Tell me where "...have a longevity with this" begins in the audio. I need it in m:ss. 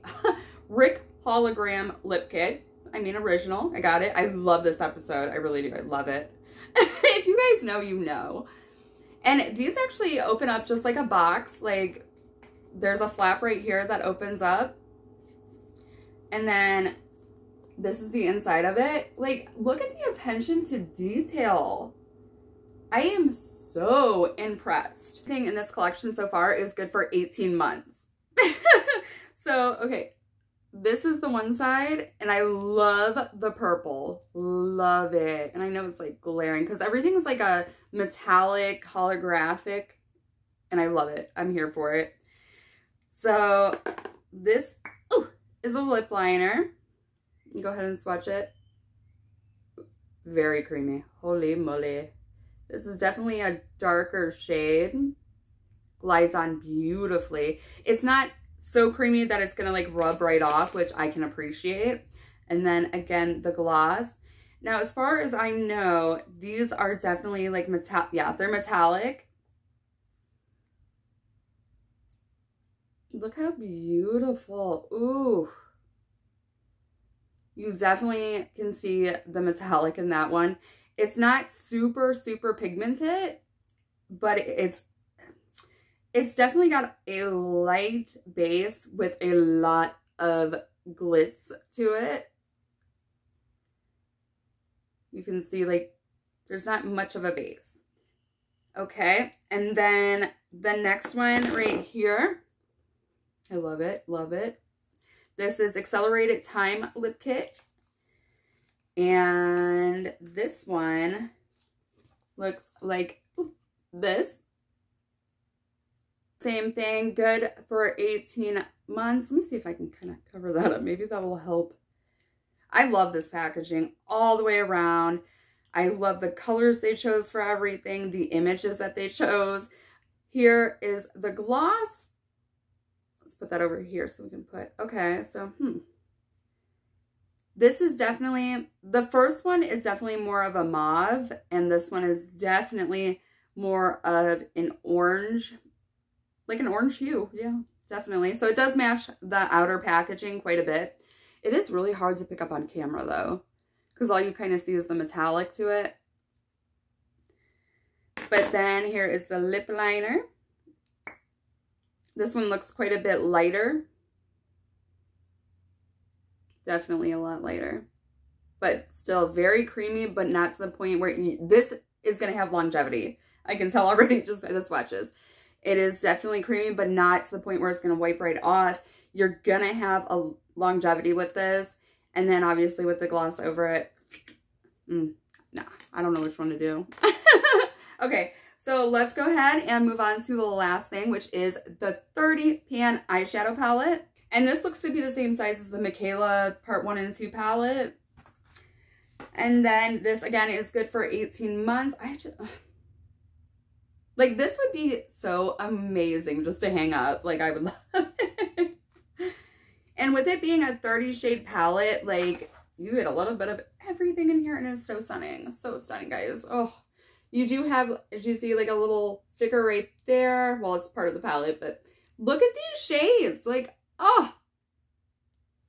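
2:59.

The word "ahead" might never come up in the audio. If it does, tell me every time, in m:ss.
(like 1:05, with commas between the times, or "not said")
0:47, 3:09.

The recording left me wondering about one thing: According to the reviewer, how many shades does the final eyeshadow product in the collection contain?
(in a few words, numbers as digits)
30.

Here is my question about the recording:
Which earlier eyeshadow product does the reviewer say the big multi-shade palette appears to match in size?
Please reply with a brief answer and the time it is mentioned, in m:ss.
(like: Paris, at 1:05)
Michaela Part 1 and 2 palette, at 3:15.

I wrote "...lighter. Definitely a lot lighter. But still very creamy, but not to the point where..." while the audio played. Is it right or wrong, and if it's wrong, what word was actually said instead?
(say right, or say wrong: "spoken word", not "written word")
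right.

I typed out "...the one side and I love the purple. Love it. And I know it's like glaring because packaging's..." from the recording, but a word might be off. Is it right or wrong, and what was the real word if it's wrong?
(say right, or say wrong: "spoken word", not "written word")
wrong: "everything", not "packaging".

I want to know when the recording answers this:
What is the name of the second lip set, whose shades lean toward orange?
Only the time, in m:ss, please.
1:45.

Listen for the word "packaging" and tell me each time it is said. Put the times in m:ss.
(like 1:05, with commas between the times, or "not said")
2:03, 2:29.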